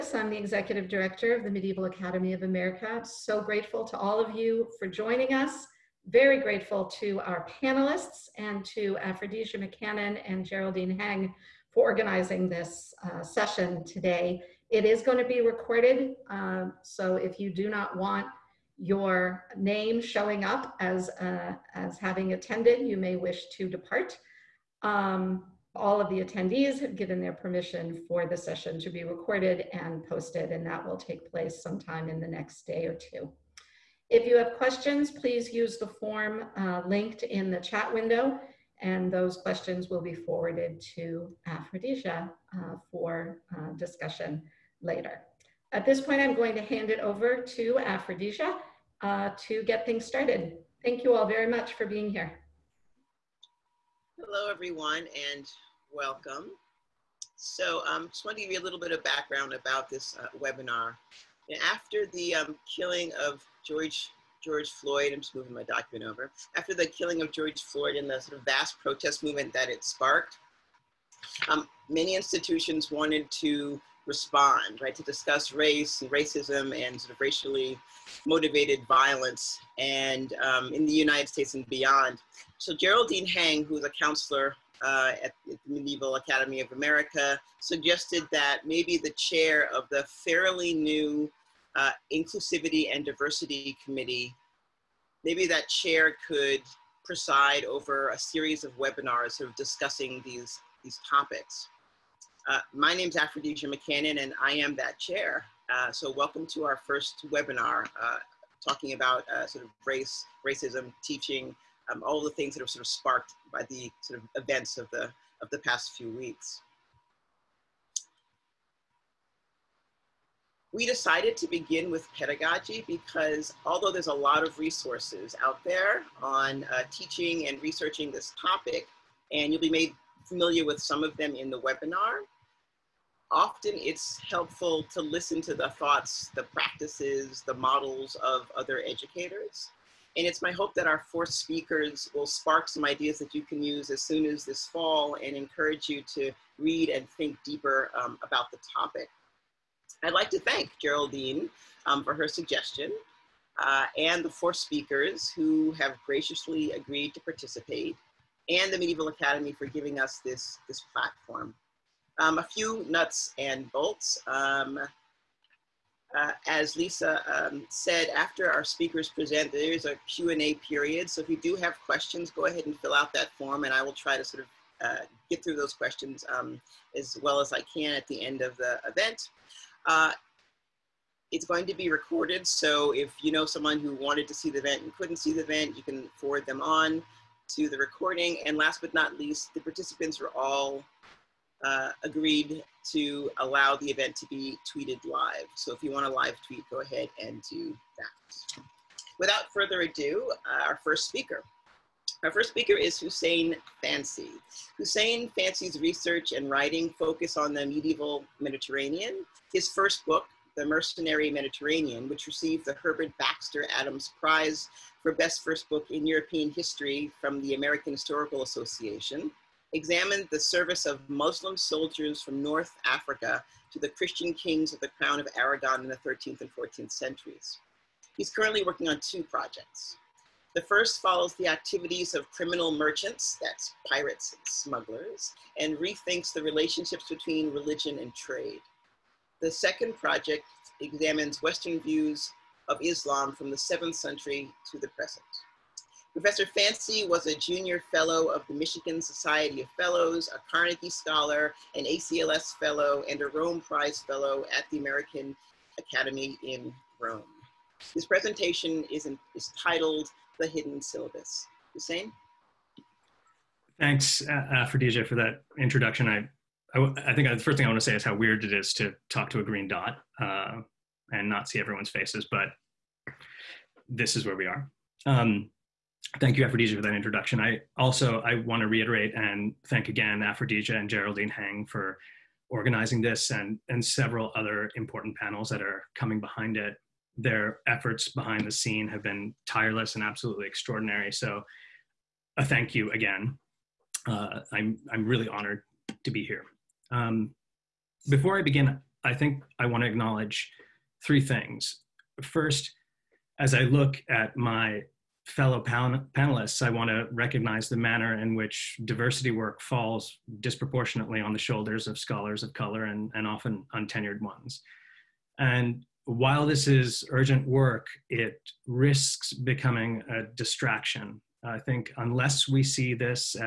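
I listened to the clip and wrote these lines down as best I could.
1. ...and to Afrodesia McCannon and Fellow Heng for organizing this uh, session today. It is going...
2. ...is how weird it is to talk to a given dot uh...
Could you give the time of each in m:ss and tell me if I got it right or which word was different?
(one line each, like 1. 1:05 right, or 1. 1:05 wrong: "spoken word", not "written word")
1. 0:08 wrong: "Geraldine", not "Fellow"
2. 4:27 wrong: "green", not "given".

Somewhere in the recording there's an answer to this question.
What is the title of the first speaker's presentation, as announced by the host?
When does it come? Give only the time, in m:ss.
4:20.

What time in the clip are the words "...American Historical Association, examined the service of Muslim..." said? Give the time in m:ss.
3:37.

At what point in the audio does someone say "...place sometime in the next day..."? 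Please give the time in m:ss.
0:31.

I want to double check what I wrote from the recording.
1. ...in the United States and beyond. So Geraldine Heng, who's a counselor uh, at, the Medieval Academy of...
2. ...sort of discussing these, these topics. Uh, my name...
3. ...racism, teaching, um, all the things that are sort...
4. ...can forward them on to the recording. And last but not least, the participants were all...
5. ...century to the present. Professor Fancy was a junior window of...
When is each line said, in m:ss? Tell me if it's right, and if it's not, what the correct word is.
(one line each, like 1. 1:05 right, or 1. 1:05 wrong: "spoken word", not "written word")
1. 1:20 right
2. 1:39 right
3. 1:50 right
4. 3:05 right
5. 4:03 wrong: "fellow", not "window".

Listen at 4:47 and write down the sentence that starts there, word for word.
Their efforts behind the scene have been tireless and absolutely extraordinary.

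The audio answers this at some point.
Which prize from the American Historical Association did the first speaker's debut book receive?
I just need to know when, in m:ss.
3:32.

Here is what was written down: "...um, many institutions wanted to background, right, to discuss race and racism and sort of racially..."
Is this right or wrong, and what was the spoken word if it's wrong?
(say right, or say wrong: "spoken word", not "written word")
wrong: "respond", not "background".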